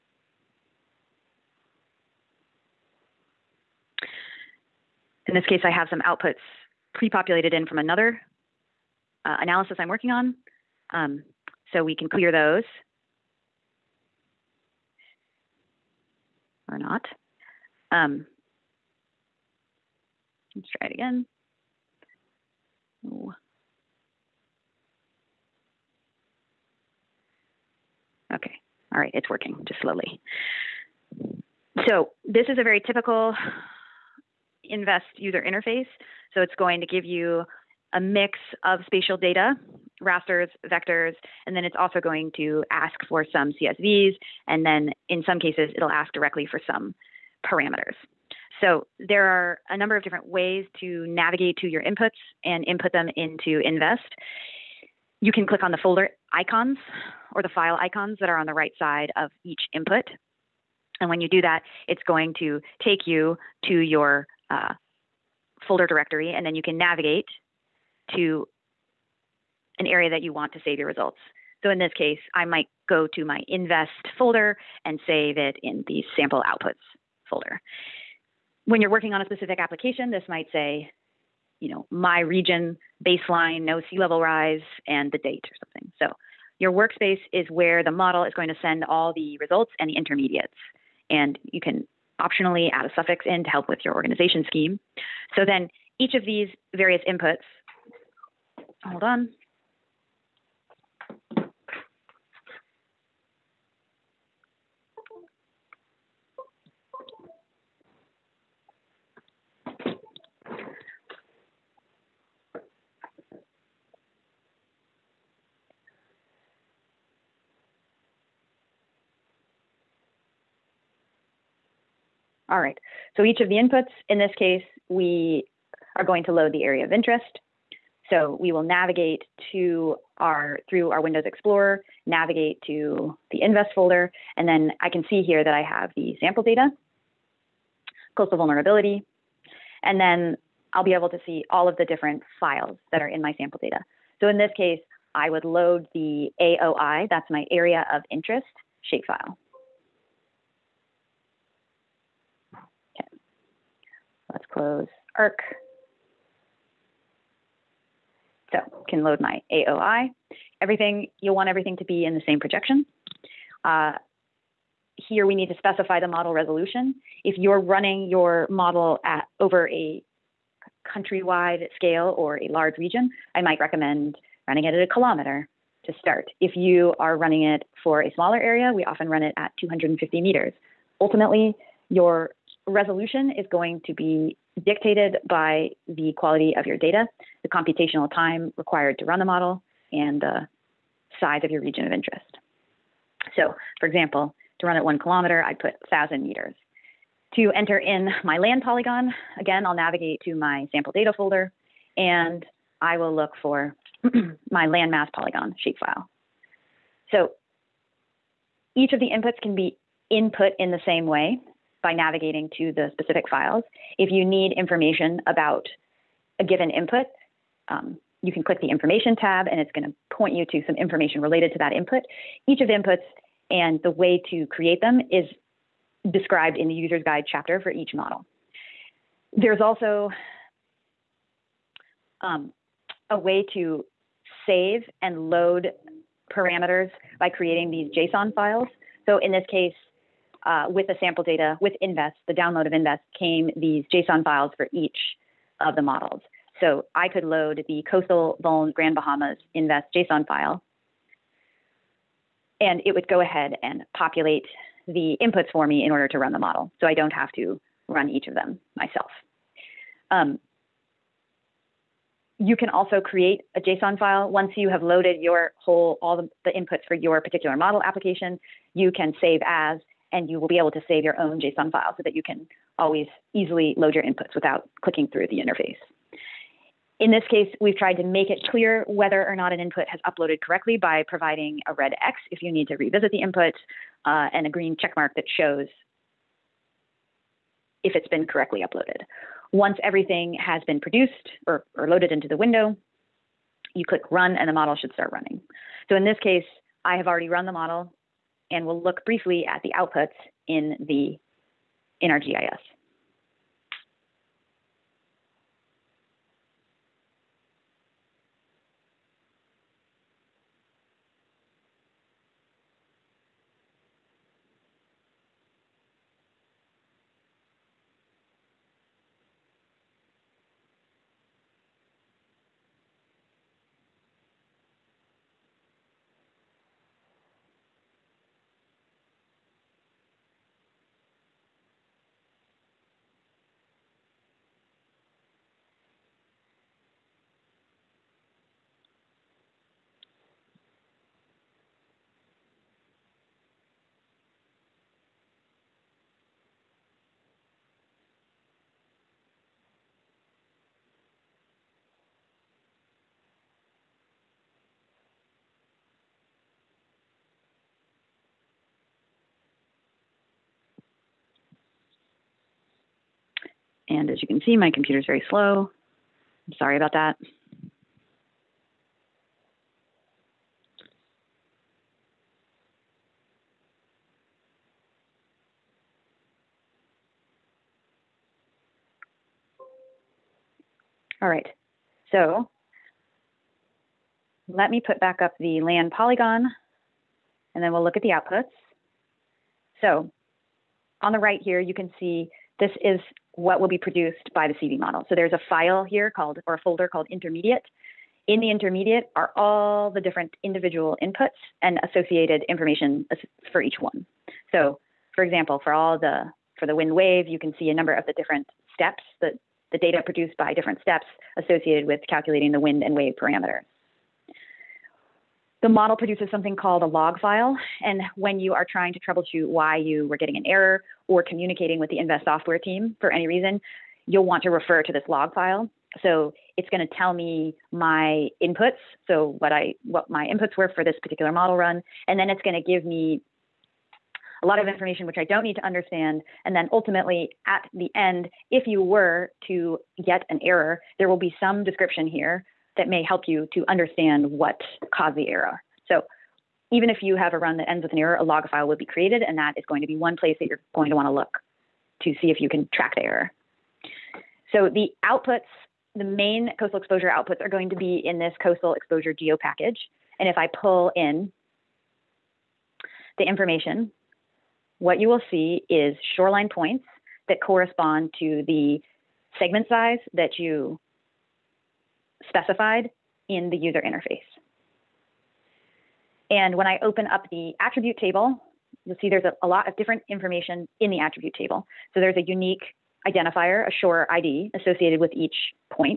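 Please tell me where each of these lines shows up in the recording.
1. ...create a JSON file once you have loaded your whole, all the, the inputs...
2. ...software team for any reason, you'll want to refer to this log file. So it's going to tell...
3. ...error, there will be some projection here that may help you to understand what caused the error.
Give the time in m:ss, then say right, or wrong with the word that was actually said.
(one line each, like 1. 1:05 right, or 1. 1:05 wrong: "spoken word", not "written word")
1. 4:23 right
2. 7:02 right
3. 7:20 wrong: "description", not "projection".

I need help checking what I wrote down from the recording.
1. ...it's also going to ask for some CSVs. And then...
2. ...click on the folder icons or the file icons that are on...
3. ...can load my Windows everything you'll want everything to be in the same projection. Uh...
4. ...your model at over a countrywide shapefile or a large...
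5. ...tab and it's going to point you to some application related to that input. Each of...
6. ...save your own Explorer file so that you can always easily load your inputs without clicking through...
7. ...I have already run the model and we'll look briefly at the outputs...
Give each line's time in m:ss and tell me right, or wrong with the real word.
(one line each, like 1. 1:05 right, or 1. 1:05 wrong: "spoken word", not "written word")
1. 0:41 right
2. 0:55 right
3. 2:38 wrong: "AOI", not "Windows"
4. 2:48 wrong: "scale", not "shapefile"
5. 3:39 wrong: "information", not "application"
6. 4:30 wrong: "JSON", not "Explorer"
7. 4:56 right.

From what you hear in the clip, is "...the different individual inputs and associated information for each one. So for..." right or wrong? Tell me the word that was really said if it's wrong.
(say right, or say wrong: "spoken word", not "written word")
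right.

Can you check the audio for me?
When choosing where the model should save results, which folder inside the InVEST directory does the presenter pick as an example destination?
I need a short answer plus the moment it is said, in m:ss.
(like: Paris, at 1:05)
sample outputs folder, at 1:16.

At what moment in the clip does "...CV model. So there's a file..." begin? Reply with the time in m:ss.
6:34.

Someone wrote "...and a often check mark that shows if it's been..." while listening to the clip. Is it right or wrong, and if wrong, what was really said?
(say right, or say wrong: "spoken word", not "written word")
wrong: "green", not "often".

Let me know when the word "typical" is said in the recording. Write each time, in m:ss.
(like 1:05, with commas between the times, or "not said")
0:32.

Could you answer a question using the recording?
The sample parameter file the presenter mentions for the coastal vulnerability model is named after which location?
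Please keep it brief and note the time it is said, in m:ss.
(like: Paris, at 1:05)
Grand Bahamas, at 4:08.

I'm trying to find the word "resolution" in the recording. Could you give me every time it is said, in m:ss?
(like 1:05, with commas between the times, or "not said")
2:46, 3:02.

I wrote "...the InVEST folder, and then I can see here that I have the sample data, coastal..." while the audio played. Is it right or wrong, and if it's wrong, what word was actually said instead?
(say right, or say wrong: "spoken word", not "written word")
right.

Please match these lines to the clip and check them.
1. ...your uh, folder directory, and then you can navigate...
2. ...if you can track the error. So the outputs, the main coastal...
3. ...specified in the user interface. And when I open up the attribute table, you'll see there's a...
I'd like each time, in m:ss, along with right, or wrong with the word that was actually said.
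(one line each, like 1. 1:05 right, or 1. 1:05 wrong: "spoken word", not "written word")
1. 1:03 right
2. 7:32 right
3. 7:52 right.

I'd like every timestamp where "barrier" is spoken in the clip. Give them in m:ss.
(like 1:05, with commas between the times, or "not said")
not said.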